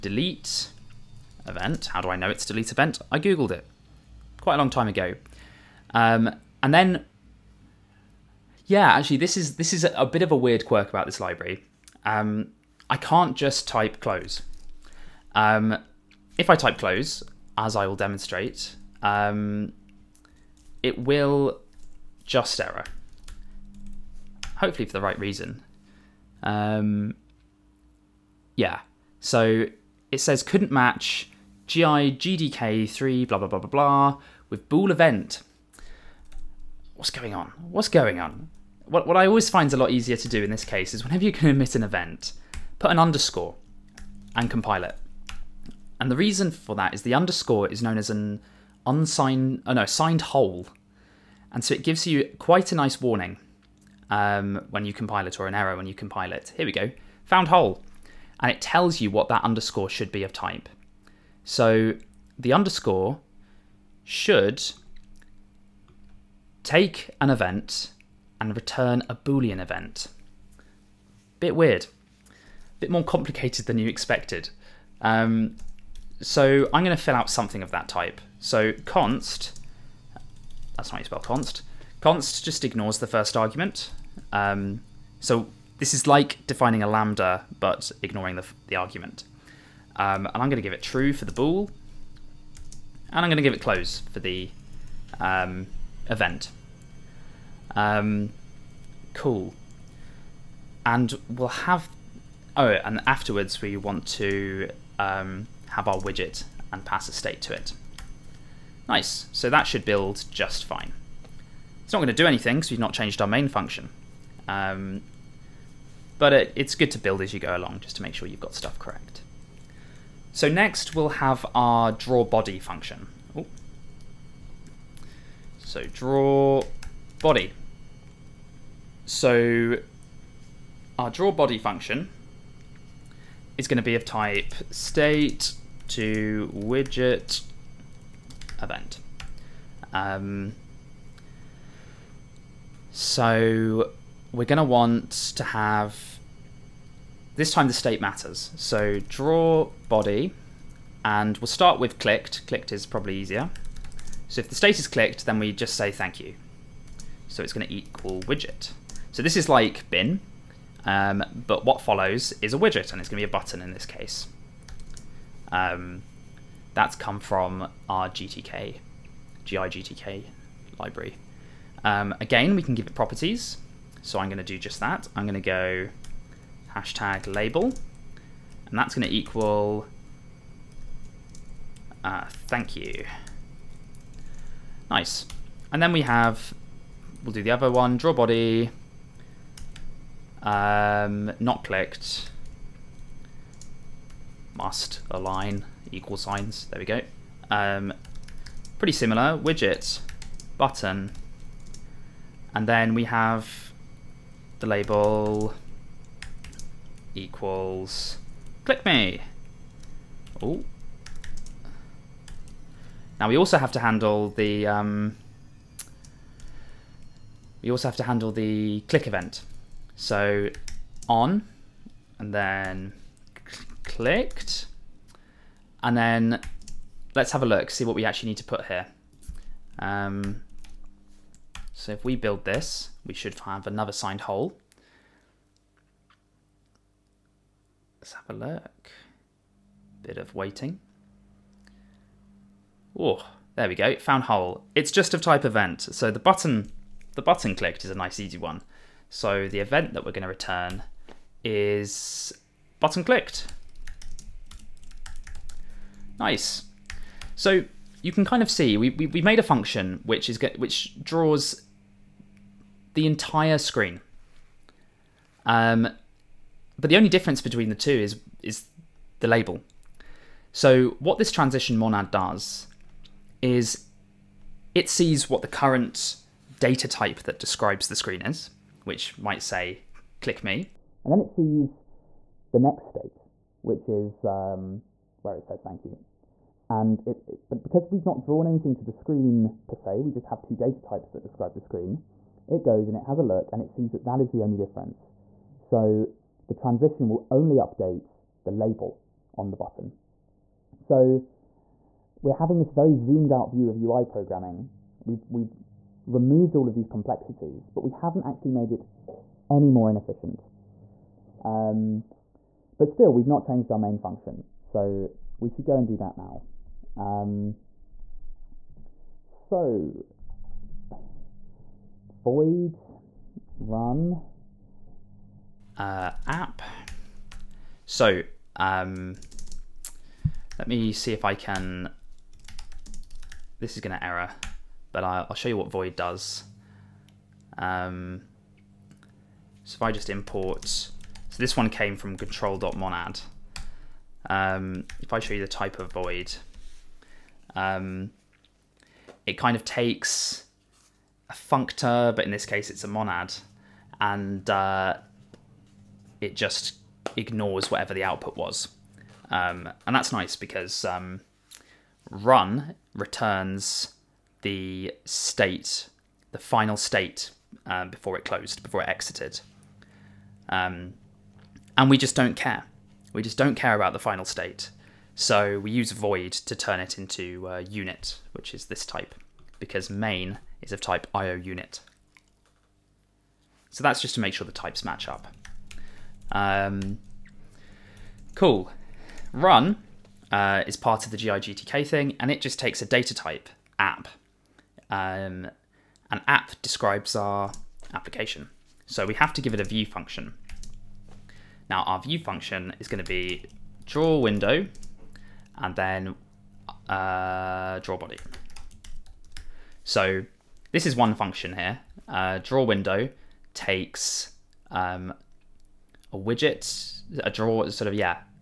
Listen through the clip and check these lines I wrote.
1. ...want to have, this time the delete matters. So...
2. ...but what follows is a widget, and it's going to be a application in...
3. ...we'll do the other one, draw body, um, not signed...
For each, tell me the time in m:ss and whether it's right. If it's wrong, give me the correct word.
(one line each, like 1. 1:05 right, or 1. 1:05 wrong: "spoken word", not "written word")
1. 2:24 wrong: "state", not "delete"
2. 2:41 wrong: "button", not "application"
3. 3:07 wrong: "clicked", not "signed".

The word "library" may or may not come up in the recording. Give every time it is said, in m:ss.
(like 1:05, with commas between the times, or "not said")
0:11, 2:50.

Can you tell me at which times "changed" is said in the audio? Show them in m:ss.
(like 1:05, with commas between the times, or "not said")
1:52, 5:13.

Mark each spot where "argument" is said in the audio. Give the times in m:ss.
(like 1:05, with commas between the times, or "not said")
1:23, 1:28.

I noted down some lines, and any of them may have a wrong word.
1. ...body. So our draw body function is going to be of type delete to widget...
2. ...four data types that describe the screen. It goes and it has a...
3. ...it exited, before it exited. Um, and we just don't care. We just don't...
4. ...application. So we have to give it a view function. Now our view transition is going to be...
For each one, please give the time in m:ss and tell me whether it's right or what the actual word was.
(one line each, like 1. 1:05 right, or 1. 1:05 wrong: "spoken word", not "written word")
1. 2:07 wrong: "state", not "delete"
2. 4:50 wrong: "two", not "four"
3. 6:08 wrong: "closed", not "exited"
4. 6:37 wrong: "function", not "transition".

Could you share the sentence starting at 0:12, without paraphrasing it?
Um, I can't just type close.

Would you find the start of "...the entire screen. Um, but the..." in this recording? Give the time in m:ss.
4:22.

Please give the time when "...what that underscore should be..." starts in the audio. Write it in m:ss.
0:59.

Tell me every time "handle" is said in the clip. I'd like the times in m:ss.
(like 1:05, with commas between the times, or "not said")
3:33, 3:38.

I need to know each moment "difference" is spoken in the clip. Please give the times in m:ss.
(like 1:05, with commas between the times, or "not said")
4:27, 4:54.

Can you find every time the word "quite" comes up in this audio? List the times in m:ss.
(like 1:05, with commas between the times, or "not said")
0:04, 0:52.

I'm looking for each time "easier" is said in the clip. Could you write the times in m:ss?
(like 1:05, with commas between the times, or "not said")
0:39, 2:33.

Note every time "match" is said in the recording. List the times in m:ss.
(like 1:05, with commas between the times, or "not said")
0:30, 6:24.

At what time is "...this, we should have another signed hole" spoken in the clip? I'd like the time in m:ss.
3:52.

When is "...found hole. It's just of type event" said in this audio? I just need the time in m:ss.
4:03.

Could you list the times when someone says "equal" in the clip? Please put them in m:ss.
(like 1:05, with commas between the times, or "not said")
2:37, 2:59, 3:15, 3:27.